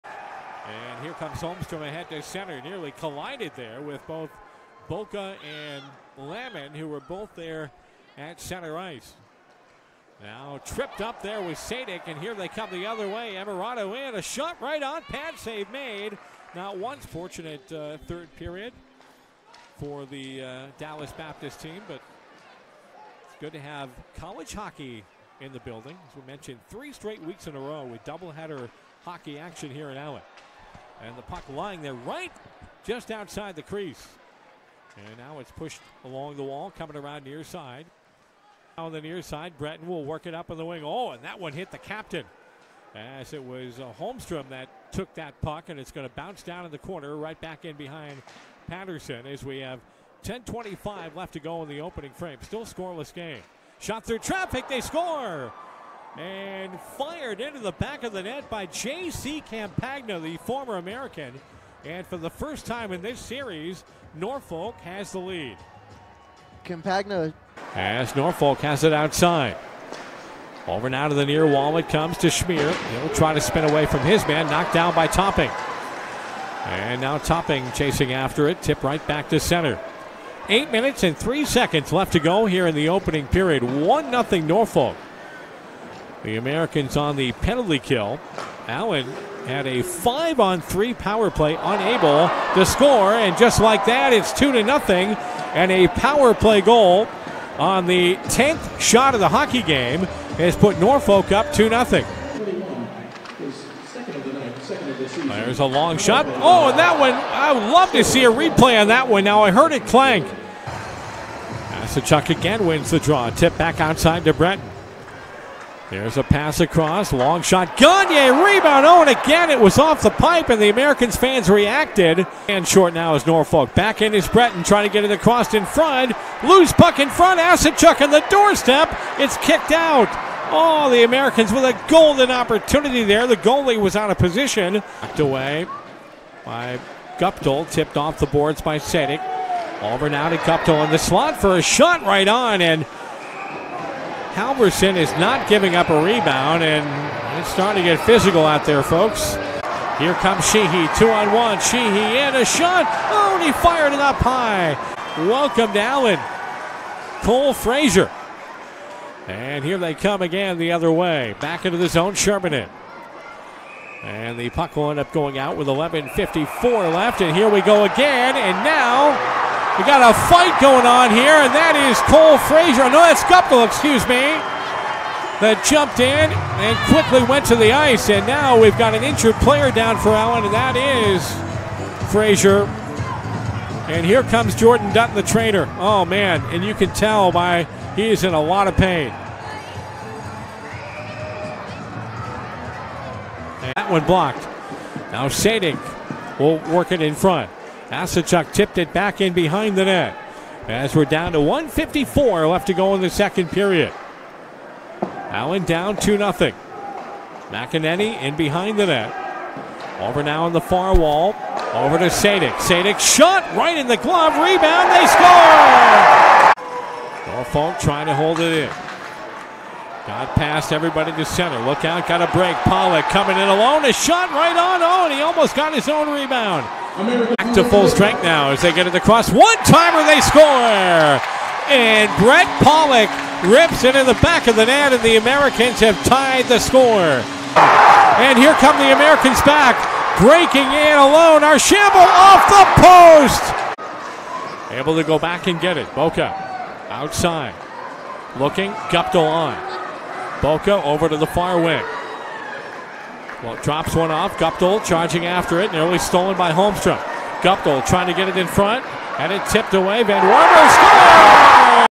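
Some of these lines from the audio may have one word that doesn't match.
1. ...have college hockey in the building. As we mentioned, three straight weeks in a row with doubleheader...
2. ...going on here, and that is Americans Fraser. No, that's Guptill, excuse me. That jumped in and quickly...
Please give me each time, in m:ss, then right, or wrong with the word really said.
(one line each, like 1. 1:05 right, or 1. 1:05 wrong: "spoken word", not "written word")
1. 0:23 right
2. 2:50 wrong: "Cole", not "Americans".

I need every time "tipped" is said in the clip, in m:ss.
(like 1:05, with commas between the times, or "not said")
2:17, 3:18, 4:19.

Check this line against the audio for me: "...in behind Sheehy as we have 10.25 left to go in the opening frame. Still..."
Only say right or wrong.
wrong.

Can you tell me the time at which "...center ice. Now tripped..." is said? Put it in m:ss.
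0:08.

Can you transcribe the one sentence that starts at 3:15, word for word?
Now Sadik will work it in front.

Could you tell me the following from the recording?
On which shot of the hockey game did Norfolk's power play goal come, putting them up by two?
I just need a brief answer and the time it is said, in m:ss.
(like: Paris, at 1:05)
10th, at 1:38.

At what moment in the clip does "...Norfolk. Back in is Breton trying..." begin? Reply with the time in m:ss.
2:03.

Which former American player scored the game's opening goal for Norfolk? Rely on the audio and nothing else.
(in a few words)
J.C. Campagna.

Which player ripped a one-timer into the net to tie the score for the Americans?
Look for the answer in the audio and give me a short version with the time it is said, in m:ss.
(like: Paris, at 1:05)
Brett Pollock, at 3:52.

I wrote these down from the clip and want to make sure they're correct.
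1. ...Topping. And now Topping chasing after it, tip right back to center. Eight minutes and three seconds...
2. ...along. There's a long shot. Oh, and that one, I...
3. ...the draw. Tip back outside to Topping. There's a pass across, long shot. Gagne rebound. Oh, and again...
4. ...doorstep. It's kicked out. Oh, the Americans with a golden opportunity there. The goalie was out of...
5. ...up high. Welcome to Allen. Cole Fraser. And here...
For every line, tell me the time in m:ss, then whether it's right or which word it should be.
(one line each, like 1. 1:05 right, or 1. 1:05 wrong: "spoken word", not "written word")
1. 1:15 right
2. 1:41 wrong: "nothing", not "along"
3. 1:52 wrong: "Breton", not "Topping"
4. 2:08 right
5. 2:33 right.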